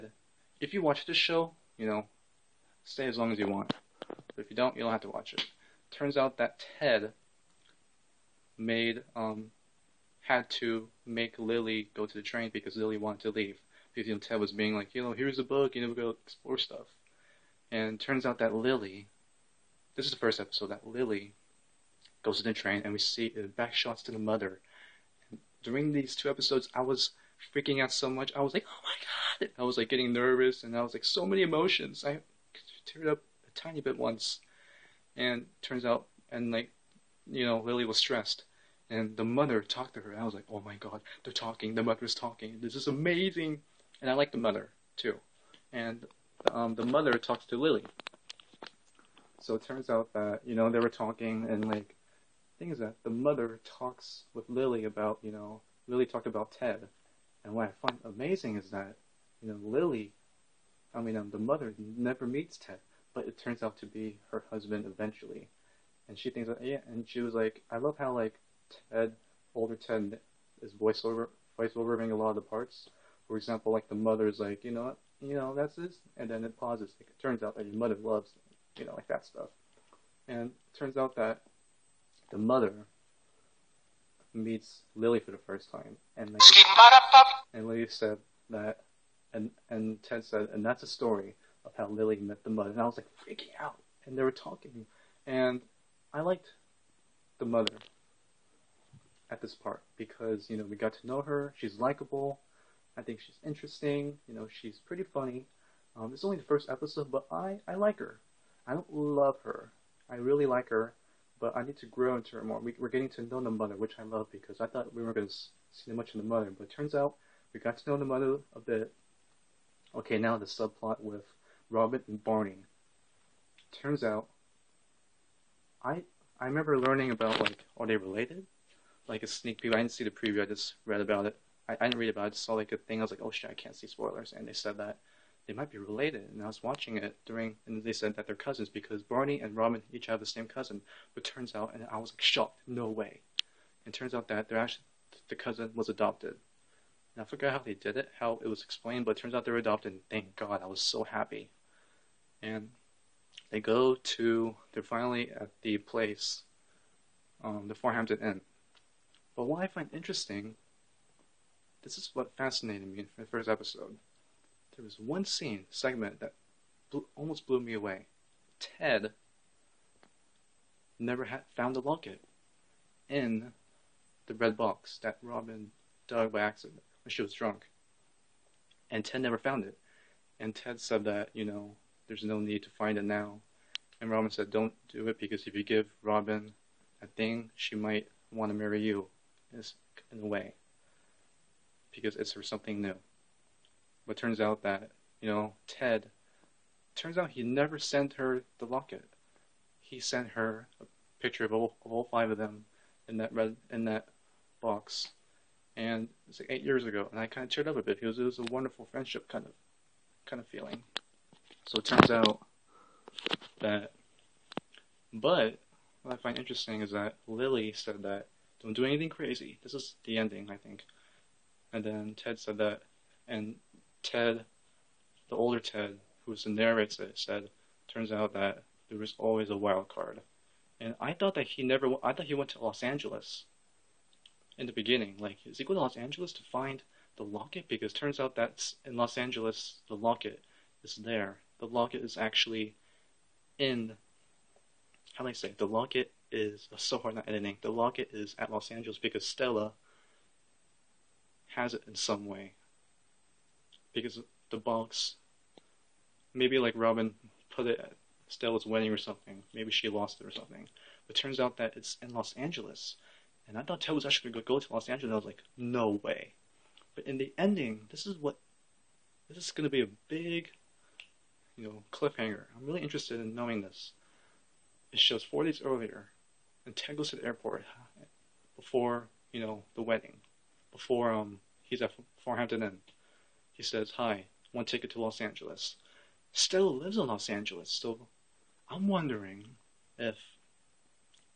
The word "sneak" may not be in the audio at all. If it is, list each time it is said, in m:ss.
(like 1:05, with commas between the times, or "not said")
2:09.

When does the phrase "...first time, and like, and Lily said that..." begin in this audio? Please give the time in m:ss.
1:25.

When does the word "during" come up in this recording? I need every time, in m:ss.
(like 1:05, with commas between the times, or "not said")
0:25, 2:17.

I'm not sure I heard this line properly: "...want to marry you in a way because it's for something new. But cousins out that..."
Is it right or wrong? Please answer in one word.
wrong.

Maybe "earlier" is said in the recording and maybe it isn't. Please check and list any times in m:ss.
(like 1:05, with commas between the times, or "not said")
4:35.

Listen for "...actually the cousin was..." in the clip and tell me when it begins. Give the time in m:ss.
2:24.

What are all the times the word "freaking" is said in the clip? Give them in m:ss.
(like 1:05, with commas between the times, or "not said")
0:27, 1:33.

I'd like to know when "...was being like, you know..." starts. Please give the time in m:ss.
0:14.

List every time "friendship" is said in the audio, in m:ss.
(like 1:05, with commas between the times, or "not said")
3:28.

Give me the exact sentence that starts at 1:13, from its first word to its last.
For example, like the mother's like, you know, what?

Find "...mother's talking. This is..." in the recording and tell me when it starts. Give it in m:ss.
0:41.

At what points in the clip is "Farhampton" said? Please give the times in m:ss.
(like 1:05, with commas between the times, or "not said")
2:37, 4:42.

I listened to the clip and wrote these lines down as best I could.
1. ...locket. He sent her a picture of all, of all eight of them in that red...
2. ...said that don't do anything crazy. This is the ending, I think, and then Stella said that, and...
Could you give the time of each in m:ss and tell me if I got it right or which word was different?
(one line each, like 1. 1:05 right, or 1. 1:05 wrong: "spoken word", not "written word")
1. 3:18 wrong: "five", not "eight"
2. 3:37 wrong: "Ted", not "Stella".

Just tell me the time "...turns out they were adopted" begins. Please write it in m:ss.
2:29.